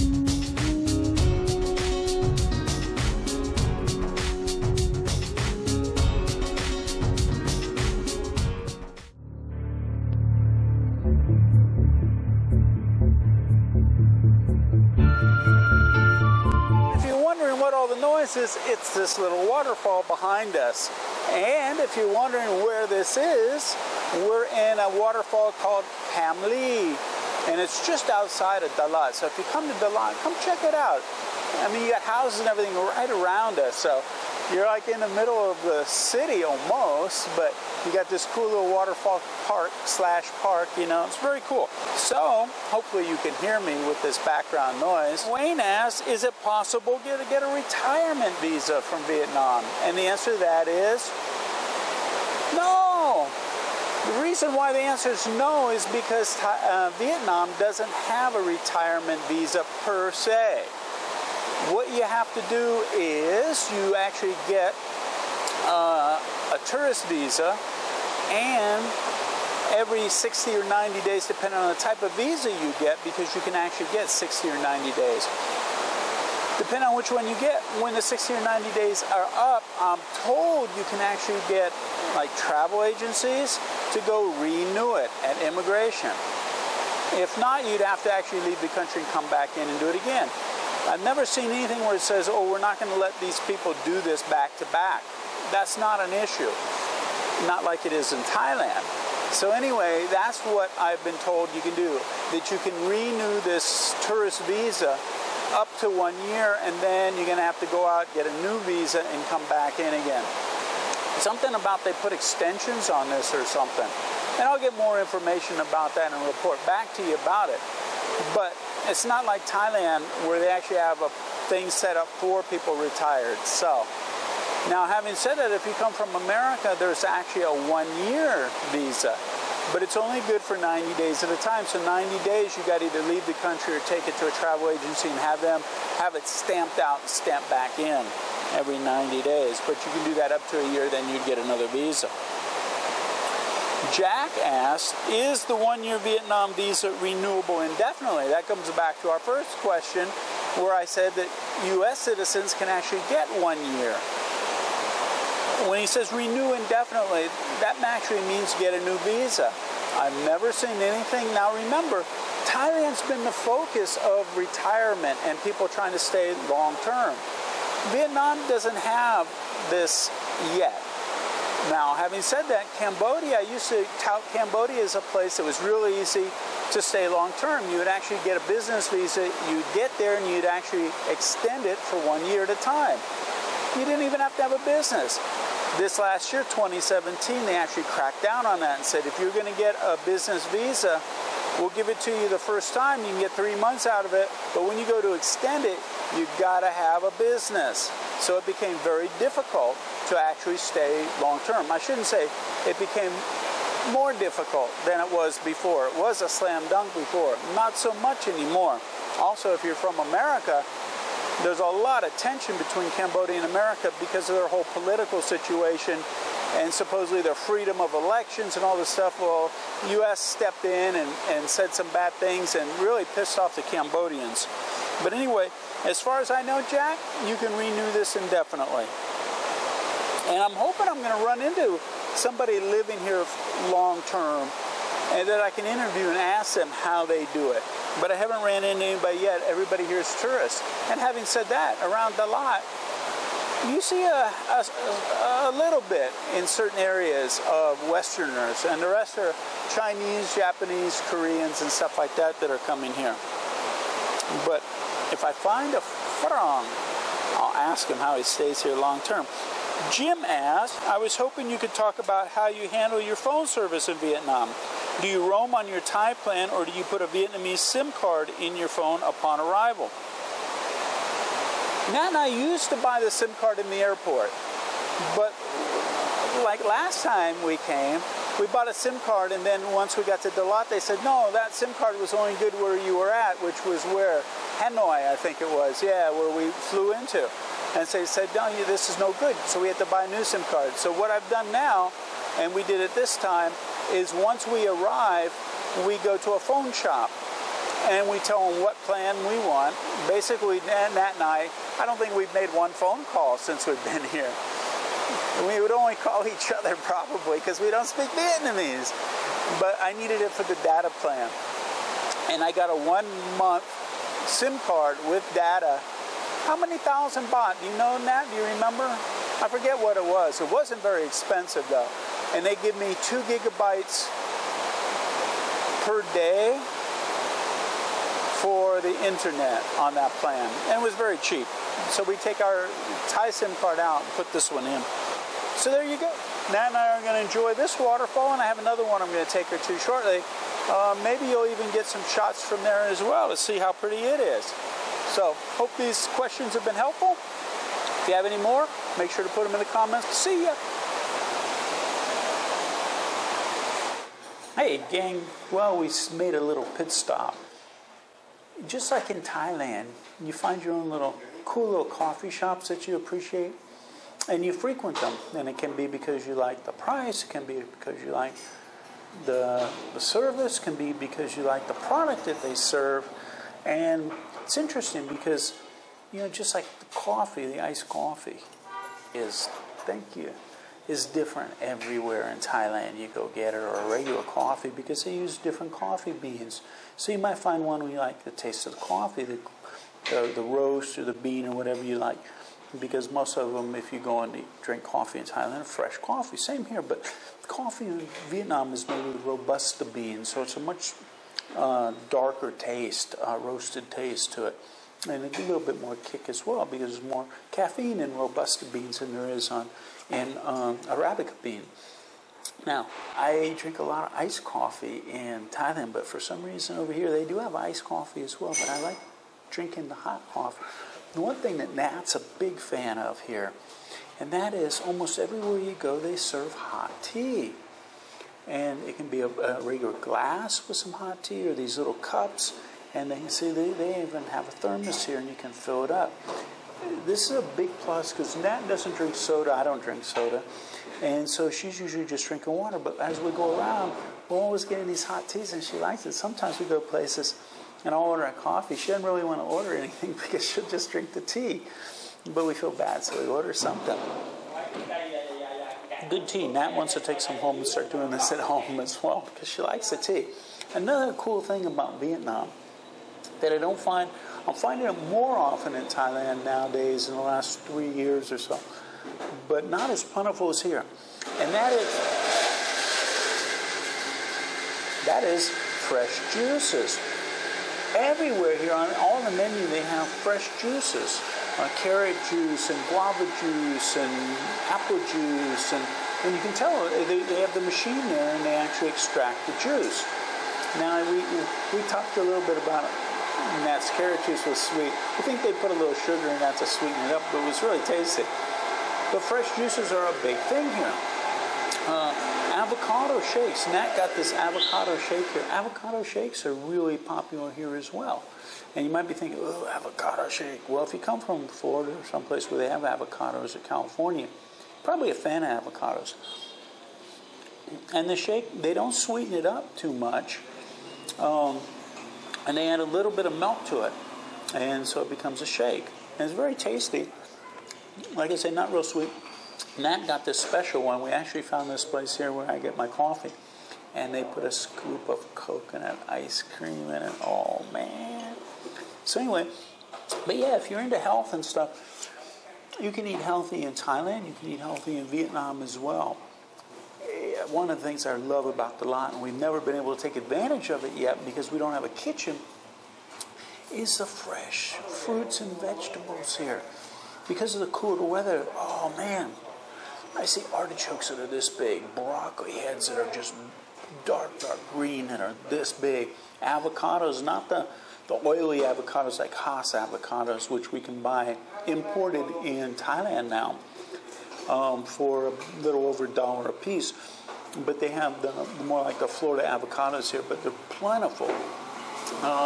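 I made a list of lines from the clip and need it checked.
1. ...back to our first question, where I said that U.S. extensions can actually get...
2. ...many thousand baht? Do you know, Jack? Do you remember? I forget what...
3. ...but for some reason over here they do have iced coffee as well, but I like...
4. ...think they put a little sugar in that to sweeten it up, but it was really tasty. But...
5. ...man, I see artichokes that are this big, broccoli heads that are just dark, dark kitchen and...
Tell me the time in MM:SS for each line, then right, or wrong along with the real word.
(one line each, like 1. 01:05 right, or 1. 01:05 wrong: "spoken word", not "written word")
1. 02:28 wrong: "citizens", not "extensions"
2. 05:16 wrong: "Nat", not "Jack"
3. 06:55 right
4. 08:15 right
5. 09:18 wrong: "green", not "kitchen".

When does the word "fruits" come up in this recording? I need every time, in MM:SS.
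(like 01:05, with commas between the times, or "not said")
09:14.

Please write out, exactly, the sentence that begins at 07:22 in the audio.
But as we go around, we're always getting these hot teas and she likes it.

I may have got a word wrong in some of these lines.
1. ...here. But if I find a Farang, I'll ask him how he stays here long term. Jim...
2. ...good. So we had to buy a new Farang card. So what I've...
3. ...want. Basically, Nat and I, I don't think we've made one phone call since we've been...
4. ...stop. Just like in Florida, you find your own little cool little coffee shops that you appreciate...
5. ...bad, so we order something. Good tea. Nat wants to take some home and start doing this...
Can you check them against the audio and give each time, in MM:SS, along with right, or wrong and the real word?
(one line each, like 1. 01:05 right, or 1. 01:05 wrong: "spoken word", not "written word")
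1. 04:12 right
2. 04:49 wrong: "SIM", not "Farang"
3. 04:59 right
4. 05:56 wrong: "Thailand", not "Florida"
5. 07:32 right.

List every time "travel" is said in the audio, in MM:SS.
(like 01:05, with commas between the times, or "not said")
01:22, 02:14.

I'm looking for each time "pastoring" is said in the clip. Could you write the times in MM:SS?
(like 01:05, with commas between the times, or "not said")
not said.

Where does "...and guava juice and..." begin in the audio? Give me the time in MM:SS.
08:02.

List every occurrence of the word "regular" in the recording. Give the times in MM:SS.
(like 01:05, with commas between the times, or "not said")
06:23, 07:09.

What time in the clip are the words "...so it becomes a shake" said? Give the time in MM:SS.
08:44.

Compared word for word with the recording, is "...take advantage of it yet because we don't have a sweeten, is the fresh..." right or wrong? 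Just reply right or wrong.
wrong.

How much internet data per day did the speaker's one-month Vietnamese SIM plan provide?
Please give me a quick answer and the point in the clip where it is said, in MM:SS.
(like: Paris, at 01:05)
2 gigabytes, at 05:23.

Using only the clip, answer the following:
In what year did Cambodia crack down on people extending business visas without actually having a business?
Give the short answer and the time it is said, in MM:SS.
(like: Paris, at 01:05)
2017, at 03:06.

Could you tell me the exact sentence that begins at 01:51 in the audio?
Something about they put extensions on this or something.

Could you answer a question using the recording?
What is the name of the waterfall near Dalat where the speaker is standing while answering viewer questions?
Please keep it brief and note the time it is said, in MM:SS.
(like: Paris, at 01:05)
Cam Ly, at 00:26.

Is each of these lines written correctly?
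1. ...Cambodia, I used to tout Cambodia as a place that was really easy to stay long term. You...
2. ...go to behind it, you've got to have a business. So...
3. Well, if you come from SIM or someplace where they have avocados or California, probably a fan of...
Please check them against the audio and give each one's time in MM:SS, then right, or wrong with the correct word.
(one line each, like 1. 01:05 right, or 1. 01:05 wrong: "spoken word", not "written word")
1. 02:52 right
2. 03:14 wrong: "extend", not "behind"
3. 08:30 wrong: "Florida", not "SIM".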